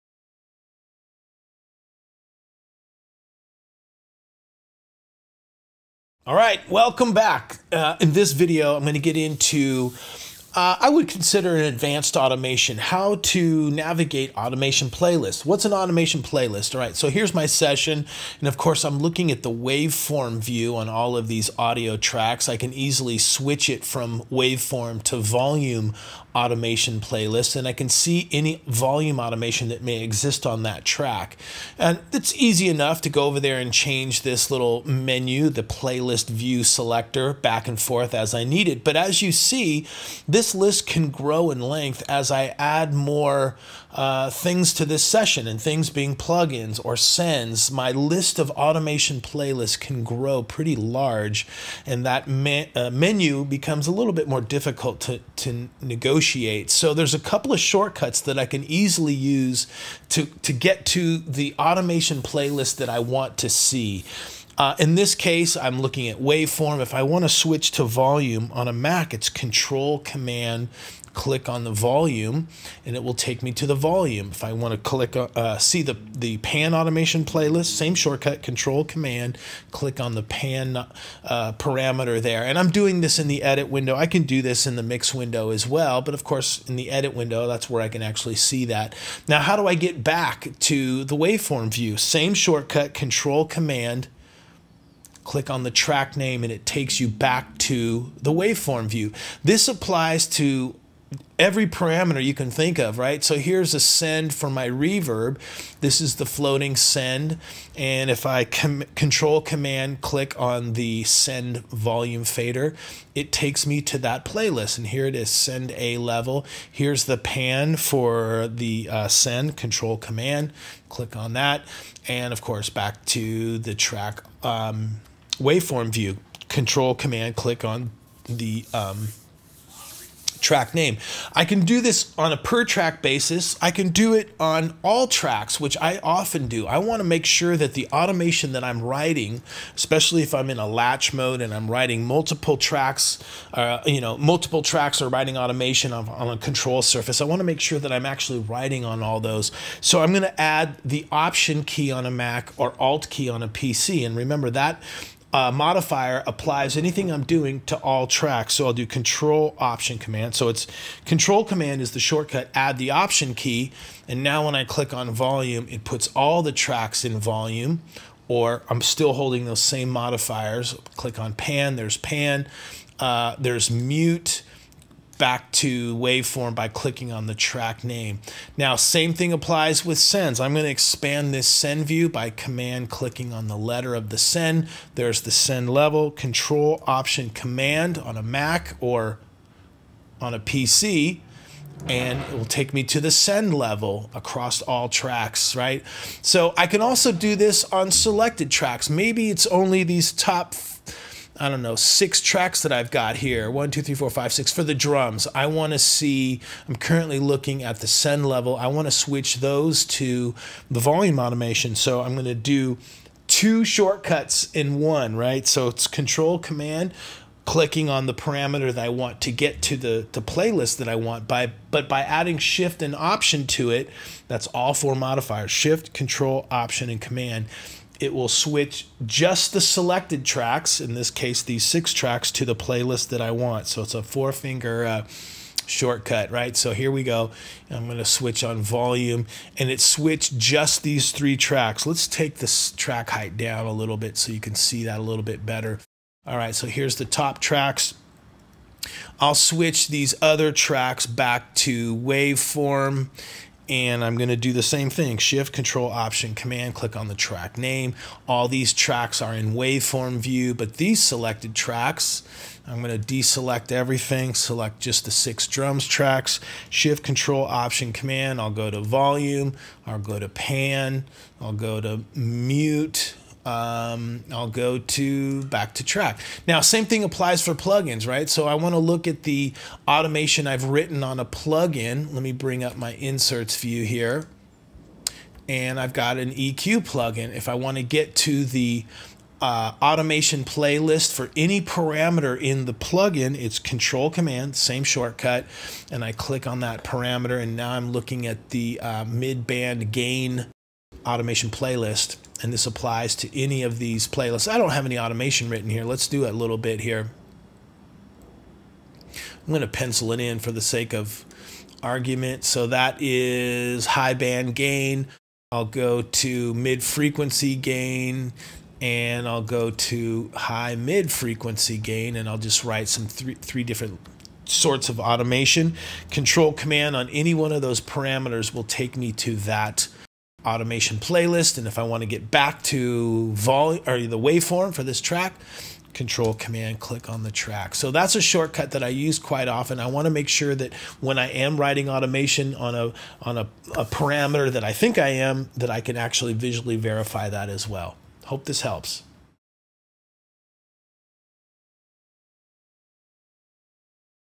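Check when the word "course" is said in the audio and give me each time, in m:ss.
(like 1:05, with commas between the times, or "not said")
0:18, 1:26, 2:02.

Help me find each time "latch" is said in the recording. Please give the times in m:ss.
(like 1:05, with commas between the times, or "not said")
2:20.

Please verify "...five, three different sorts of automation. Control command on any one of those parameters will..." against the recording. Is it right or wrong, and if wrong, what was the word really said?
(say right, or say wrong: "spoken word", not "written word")
wrong: "three", not "five".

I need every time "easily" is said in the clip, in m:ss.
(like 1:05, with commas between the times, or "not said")
0:22, 0:58.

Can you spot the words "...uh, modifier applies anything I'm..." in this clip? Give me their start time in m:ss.
2:35.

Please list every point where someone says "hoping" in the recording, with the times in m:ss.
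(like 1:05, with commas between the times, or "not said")
not said.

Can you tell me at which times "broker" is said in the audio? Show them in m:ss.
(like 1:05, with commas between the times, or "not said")
not said.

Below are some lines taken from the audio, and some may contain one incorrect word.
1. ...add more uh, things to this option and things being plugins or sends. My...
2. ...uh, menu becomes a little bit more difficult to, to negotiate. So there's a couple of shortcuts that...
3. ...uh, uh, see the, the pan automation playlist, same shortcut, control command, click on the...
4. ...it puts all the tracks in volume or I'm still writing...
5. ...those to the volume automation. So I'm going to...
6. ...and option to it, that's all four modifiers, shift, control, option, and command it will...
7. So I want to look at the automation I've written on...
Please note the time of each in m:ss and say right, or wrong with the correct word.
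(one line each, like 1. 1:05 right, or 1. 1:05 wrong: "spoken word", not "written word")
1. 0:42 wrong: "session", not "option"
2. 0:52 right
3. 1:15 right
4. 2:45 wrong: "holding", not "writing"
5. 3:29 right
6. 3:42 right
7. 4:38 right.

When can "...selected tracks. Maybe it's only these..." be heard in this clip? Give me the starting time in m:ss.
3:17.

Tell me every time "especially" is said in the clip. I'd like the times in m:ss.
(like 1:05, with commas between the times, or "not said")
2:19.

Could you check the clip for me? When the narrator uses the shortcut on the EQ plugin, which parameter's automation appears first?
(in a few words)
mid-band gain.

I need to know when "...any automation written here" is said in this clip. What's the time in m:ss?
5:04.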